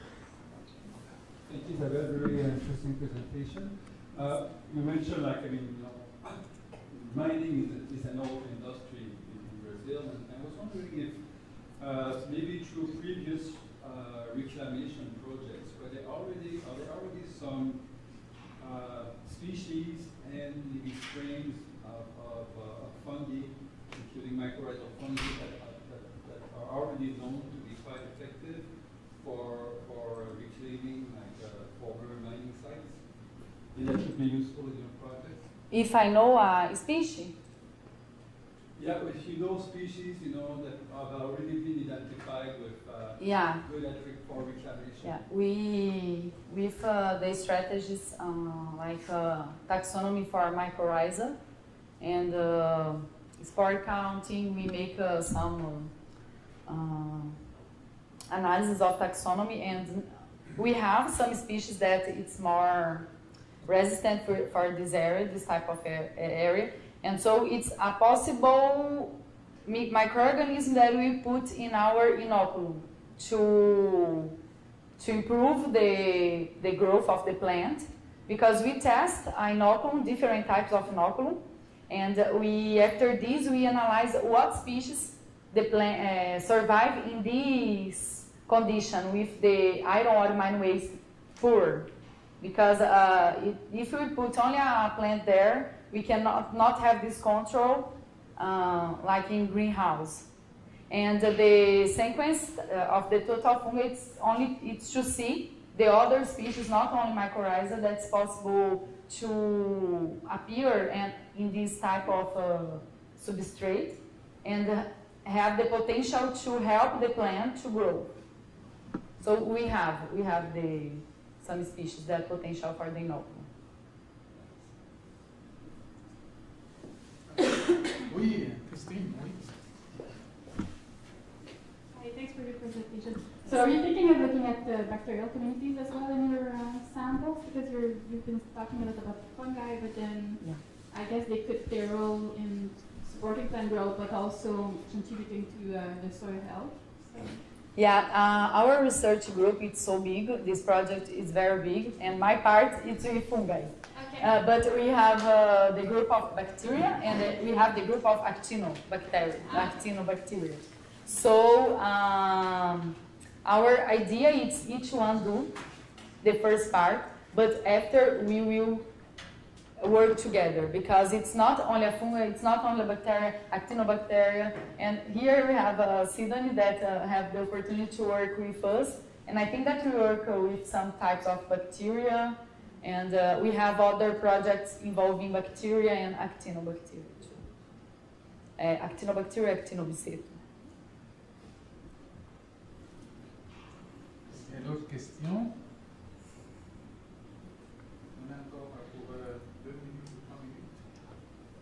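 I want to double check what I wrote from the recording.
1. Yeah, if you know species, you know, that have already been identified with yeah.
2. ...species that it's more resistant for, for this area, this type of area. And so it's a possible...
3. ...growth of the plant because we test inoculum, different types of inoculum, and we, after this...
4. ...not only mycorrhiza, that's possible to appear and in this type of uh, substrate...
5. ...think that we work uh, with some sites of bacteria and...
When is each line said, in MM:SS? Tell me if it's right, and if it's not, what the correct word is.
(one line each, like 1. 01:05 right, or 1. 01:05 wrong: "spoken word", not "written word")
1. 00:38 right
2. 01:01 right
3. 01:16 right
4. 01:46 right
5. 02:59 wrong: "types", not "sites".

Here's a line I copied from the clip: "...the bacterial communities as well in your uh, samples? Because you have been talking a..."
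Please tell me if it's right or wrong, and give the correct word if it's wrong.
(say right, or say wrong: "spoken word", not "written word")
right.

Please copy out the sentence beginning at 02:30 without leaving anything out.
This project is very big, and my part is with fungi.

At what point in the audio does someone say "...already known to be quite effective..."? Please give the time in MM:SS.
00:26.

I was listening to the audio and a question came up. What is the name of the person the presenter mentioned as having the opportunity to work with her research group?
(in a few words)
Sidon.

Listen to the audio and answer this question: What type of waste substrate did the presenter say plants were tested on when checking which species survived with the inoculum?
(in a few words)
iron ore mine waste.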